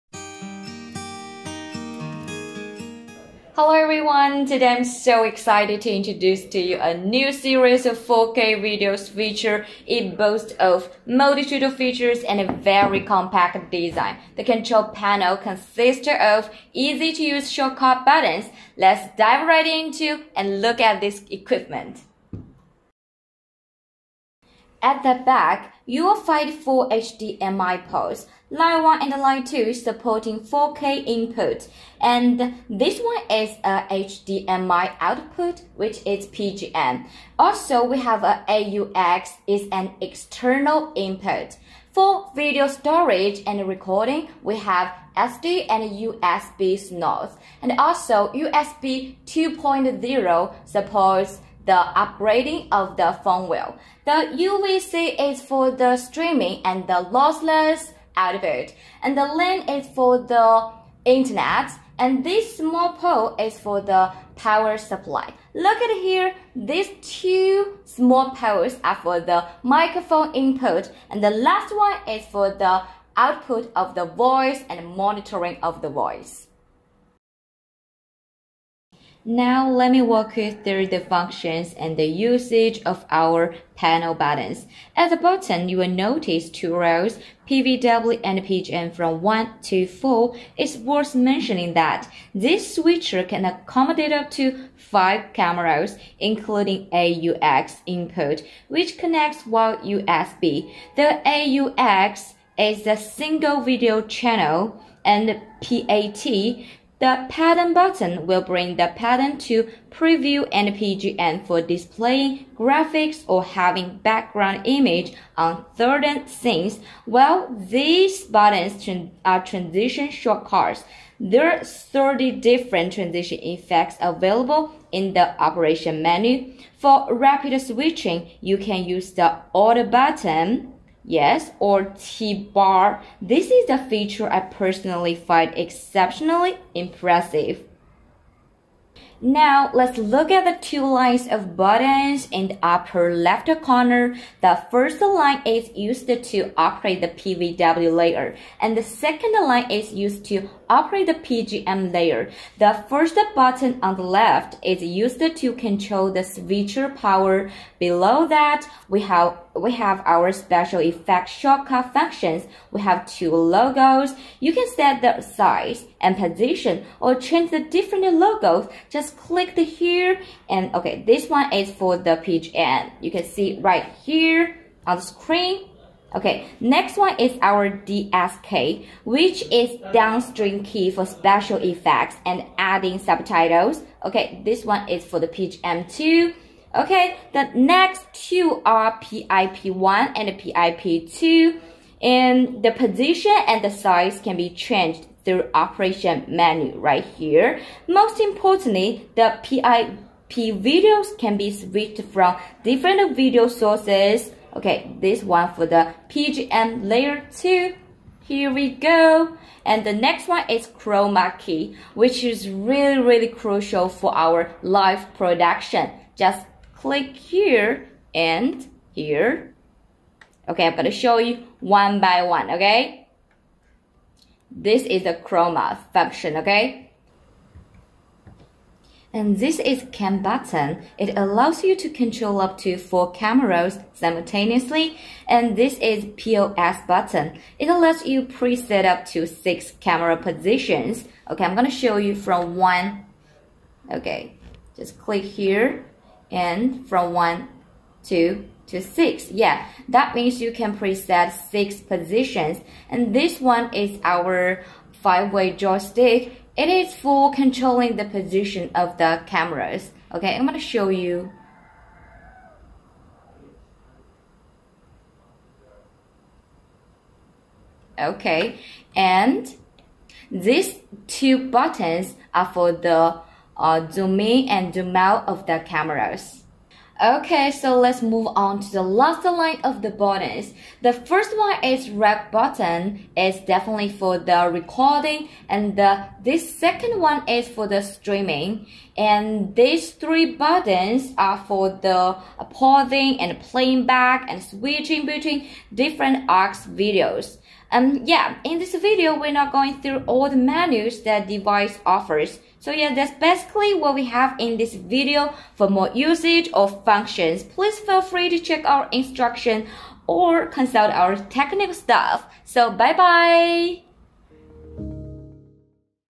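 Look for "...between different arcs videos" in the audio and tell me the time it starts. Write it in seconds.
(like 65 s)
295 s.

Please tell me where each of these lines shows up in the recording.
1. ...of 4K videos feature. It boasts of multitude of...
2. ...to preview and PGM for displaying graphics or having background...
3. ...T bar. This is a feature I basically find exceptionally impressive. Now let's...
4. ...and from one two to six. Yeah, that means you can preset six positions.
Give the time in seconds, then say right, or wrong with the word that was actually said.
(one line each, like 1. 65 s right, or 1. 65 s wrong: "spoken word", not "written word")
1. 7 s right
2. 109 s right
3. 131 s wrong: "personally", not "basically"
4. 246 s right.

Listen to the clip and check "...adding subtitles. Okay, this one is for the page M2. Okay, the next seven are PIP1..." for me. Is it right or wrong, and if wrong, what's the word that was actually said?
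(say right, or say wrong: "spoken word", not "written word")
wrong: "two", not "seven".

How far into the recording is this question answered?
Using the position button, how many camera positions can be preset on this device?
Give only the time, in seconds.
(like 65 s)
238 s.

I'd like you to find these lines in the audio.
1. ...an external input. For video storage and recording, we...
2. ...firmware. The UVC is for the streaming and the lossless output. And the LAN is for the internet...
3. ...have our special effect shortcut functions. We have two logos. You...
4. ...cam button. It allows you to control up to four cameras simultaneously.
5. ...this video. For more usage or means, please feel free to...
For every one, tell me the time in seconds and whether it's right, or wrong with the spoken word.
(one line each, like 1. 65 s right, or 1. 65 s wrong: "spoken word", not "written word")
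1. 39 s right
2. 53 s right
3. 159 s right
4. 229 s right
5. 304 s wrong: "functions", not "means".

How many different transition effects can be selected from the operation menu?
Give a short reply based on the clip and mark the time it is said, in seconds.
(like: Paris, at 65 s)
30, at 121 s.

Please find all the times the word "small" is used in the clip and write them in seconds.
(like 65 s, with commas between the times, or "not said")
62 s, 67 s.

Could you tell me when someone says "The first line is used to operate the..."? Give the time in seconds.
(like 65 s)
144 s.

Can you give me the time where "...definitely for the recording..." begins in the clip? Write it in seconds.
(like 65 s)
283 s.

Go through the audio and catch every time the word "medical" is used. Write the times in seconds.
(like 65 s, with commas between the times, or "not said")
not said.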